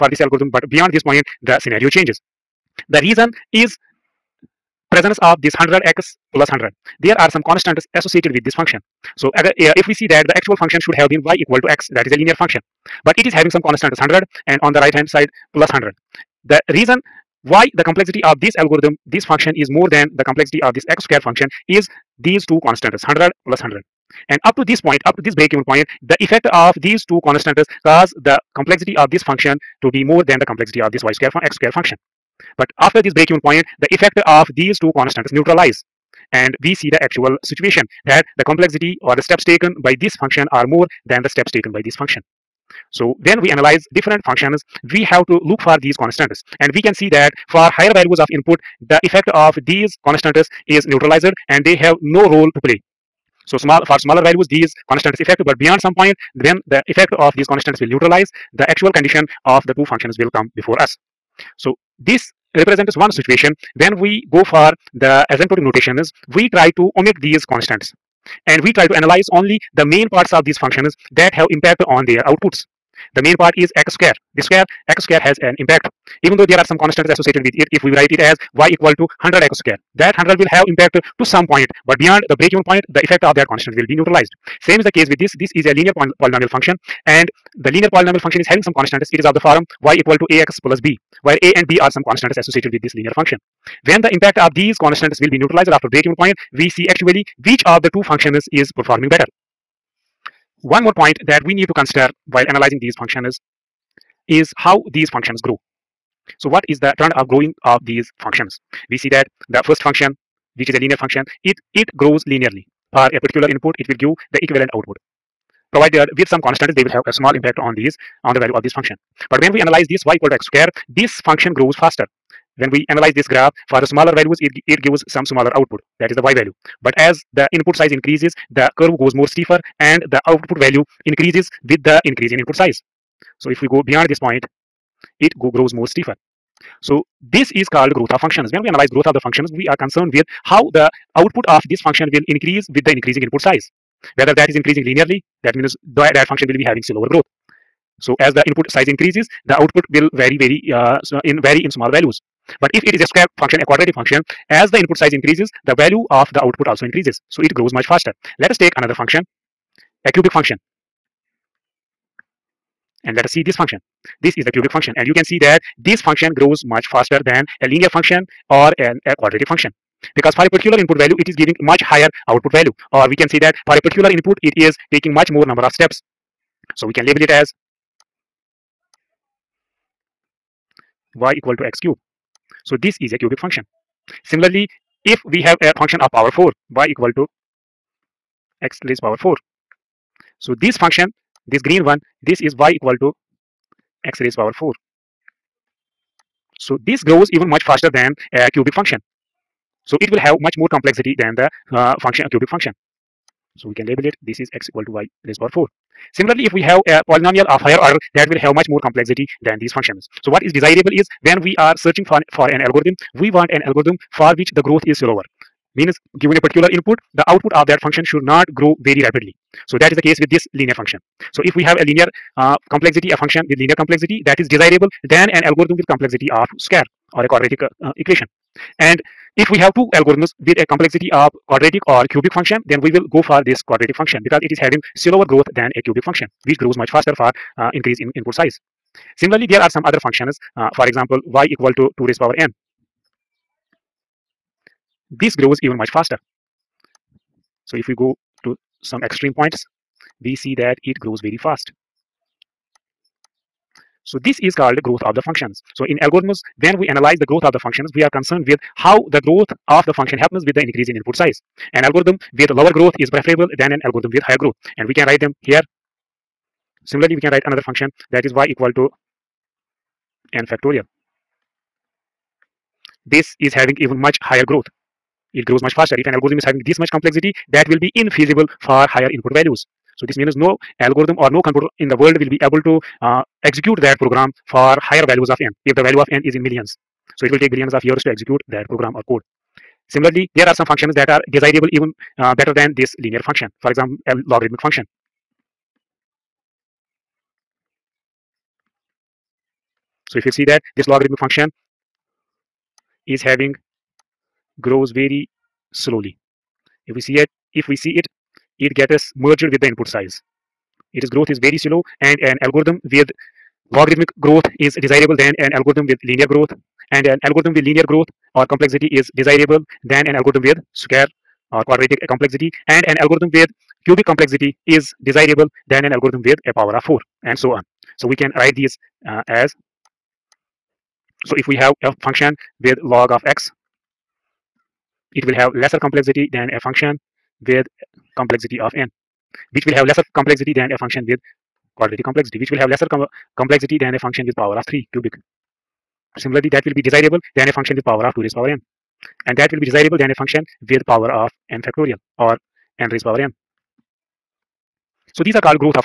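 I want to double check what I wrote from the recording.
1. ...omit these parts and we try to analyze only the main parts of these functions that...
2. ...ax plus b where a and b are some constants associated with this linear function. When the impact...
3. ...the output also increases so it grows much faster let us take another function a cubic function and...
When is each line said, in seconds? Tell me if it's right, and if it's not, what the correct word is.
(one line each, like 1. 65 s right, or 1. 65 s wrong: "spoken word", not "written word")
1. 66 s wrong: "constants", not "parts"
2. 90 s right
3. 156 s right.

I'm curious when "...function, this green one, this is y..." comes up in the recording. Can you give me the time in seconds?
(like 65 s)
190 s.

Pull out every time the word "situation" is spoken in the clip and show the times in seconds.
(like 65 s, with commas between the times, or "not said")
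37 s, 63 s.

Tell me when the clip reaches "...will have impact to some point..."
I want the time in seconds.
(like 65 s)
80 s.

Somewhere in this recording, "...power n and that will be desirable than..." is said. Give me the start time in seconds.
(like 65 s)
348 s.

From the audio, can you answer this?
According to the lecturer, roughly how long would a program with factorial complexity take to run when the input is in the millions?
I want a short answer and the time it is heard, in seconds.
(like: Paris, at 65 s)
billions of years, at 287 s.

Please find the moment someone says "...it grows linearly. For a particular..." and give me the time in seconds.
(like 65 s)
111 s.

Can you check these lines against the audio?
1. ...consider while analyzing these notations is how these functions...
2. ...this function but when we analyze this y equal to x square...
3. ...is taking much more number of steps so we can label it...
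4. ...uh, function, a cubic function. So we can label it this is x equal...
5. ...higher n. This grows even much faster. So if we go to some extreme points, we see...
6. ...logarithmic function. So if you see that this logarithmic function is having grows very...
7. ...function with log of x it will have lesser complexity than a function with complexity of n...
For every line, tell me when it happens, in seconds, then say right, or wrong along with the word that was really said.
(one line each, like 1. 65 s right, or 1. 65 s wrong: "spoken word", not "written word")
1. 101 s wrong: "functions", not "notations"
2. 118 s right
3. 174 s right
4. 201 s right
5. 242 s wrong: "power", not "higher"
6. 294 s right
7. 332 s right.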